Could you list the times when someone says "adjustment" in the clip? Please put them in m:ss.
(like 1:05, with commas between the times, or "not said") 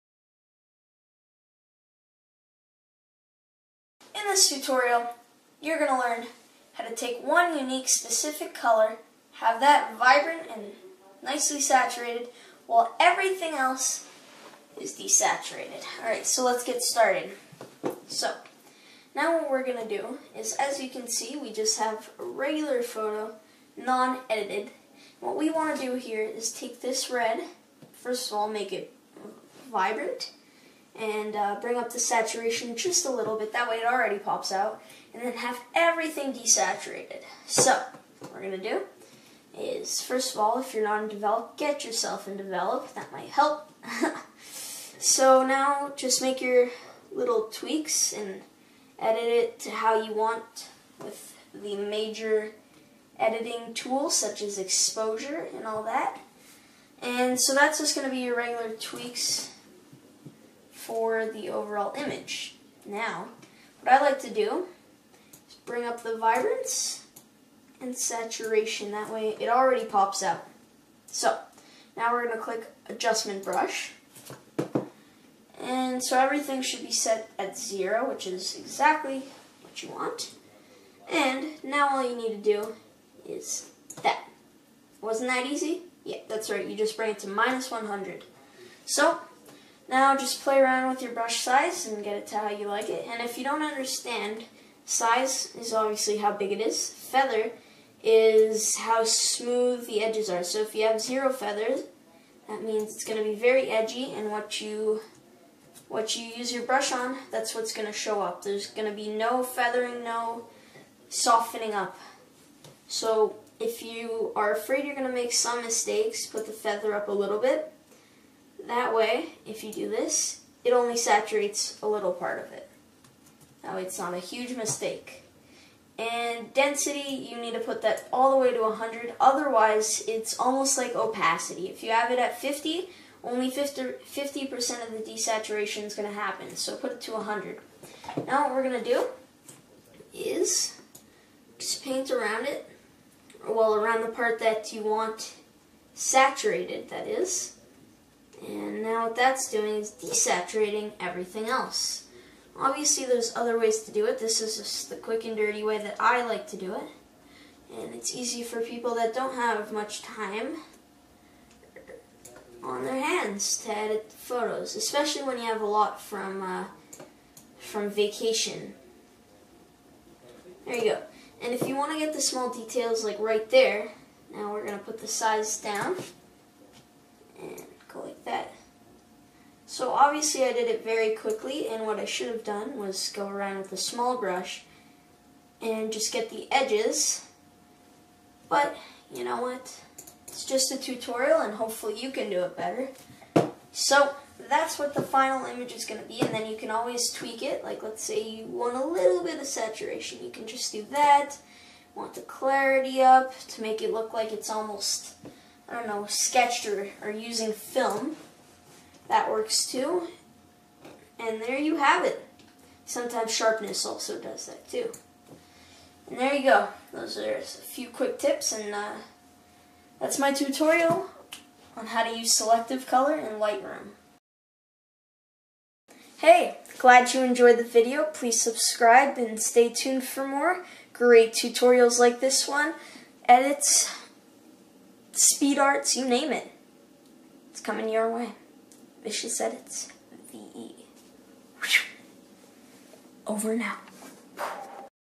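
1:12.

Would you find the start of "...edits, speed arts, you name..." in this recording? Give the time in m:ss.
3:53.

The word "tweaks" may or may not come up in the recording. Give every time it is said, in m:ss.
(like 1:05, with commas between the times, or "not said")
0:47, 0:58, 3:17.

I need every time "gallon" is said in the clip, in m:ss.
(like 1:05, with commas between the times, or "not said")
not said.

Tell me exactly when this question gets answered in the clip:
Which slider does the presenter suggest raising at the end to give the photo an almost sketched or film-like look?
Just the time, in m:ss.
3:22.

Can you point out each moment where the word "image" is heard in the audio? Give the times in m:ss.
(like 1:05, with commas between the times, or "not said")
1:01, 3:15.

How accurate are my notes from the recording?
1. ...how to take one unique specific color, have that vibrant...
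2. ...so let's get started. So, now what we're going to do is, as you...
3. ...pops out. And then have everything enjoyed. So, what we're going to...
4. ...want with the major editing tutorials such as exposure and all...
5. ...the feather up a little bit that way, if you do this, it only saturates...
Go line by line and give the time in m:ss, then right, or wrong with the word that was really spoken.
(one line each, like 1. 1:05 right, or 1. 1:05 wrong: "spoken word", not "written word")
1. 0:06 right
2. 0:16 right
3. 0:34 wrong: "desaturated", not "enjoyed"
4. 0:50 wrong: "tools", not "tutorials"
5. 1:56 right.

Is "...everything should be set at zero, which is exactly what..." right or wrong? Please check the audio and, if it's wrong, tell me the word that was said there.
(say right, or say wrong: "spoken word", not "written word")
right.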